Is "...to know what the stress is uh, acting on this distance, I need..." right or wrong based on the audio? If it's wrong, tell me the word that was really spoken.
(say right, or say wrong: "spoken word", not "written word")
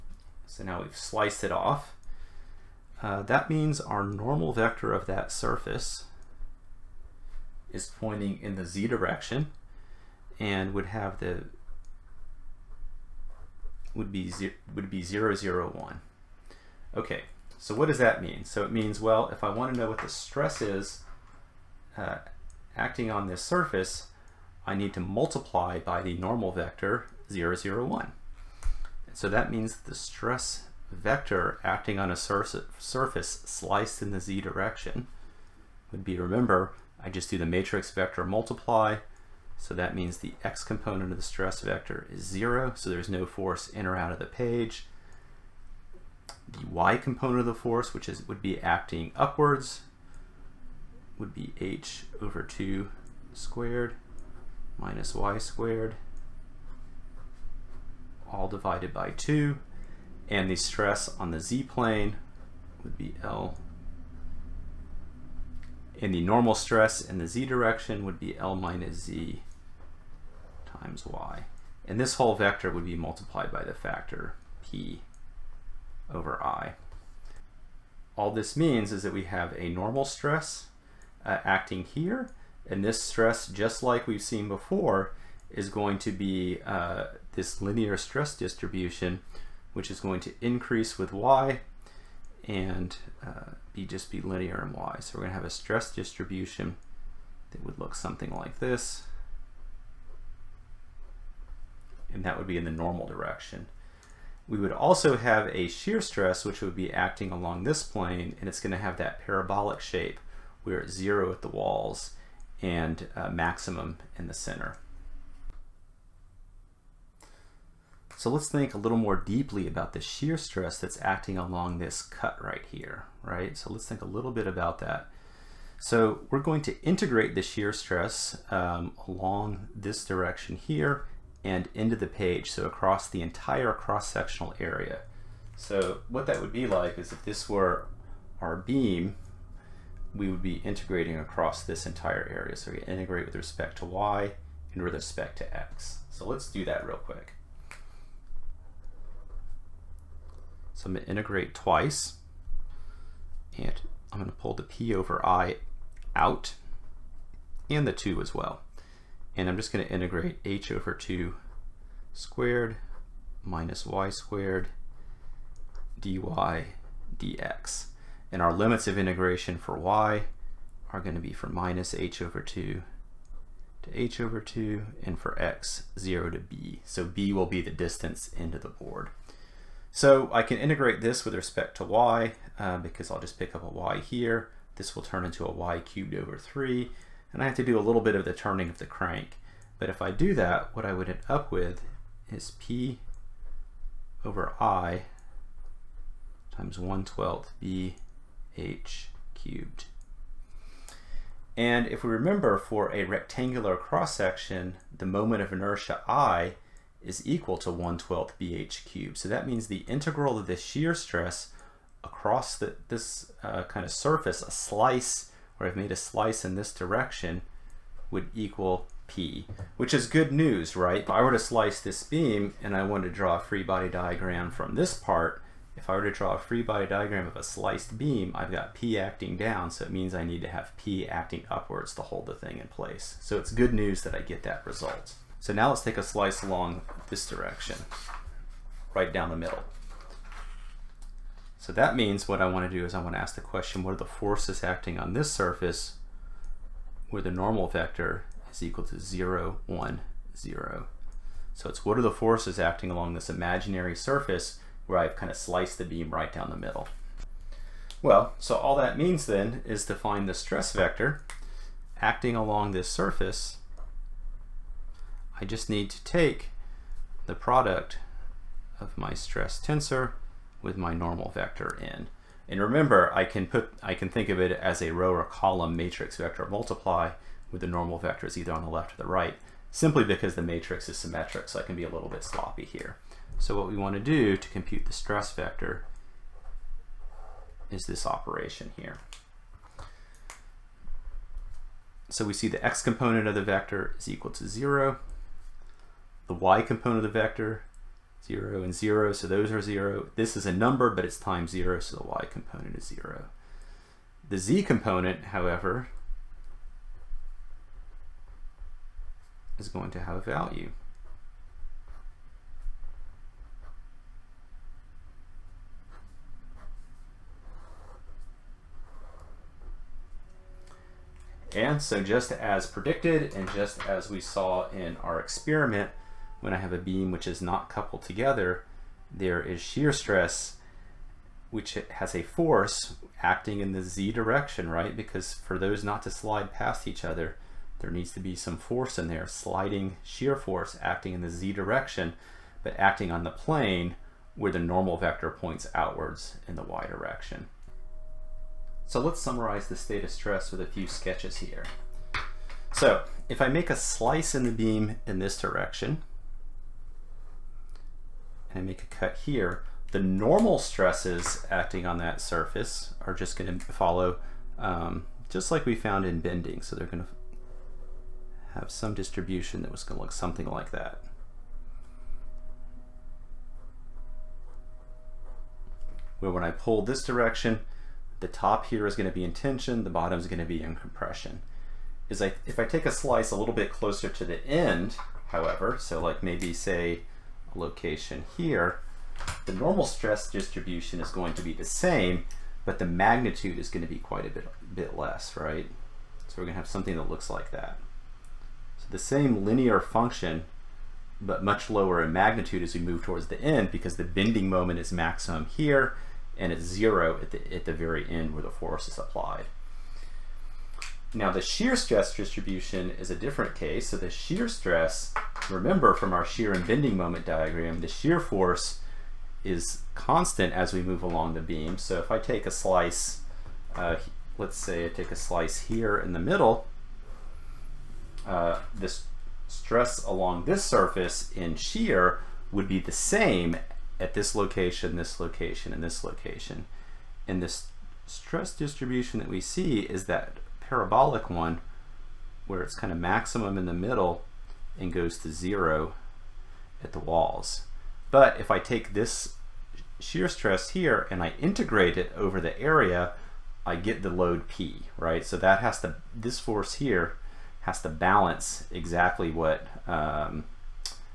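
wrong: "surface", not "distance".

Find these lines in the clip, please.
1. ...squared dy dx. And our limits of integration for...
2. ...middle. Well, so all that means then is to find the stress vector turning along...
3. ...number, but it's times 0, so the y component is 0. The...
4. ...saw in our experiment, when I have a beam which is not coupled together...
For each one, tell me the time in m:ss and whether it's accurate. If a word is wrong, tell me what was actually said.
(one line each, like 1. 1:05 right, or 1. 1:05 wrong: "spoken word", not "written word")
1. 2:44 right
2. 4:16 wrong: "acting", not "turning"
3. 5:00 right
4. 5:24 right.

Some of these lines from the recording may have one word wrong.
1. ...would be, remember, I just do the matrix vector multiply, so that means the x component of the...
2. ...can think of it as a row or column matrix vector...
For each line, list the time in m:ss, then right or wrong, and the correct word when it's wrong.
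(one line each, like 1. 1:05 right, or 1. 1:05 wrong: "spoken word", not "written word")
1. 0:35 right
2. 4:33 right.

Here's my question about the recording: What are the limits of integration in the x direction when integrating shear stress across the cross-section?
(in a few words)
0 to b.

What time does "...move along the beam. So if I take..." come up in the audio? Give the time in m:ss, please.
7:00.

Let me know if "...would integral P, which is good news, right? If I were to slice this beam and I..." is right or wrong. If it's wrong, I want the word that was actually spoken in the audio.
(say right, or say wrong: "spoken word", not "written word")
wrong: "equal", not "integral".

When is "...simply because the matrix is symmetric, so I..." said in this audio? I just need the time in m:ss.
4:39.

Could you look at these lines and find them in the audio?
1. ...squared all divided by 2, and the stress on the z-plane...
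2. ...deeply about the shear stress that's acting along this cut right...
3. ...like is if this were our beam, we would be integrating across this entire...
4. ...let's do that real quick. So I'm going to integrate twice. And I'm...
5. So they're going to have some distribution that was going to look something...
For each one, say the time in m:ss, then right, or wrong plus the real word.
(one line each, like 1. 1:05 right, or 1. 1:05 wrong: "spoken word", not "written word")
1. 0:55 right
2. 1:59 right
3. 2:16 right
4. 2:26 right
5. 6:06 right.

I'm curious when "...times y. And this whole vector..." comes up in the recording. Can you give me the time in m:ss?
1:10.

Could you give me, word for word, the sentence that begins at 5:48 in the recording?
So let's summarize the state of stress with a few sketches here.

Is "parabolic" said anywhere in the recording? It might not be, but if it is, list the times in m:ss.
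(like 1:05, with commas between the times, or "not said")
1:49, 7:20.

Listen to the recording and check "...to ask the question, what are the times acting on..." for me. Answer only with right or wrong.
wrong.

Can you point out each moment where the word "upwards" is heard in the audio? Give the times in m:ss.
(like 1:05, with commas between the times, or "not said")
0:49, 3:51.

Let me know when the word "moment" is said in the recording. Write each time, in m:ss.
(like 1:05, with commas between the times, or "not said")
3:25, 6:44, 6:56.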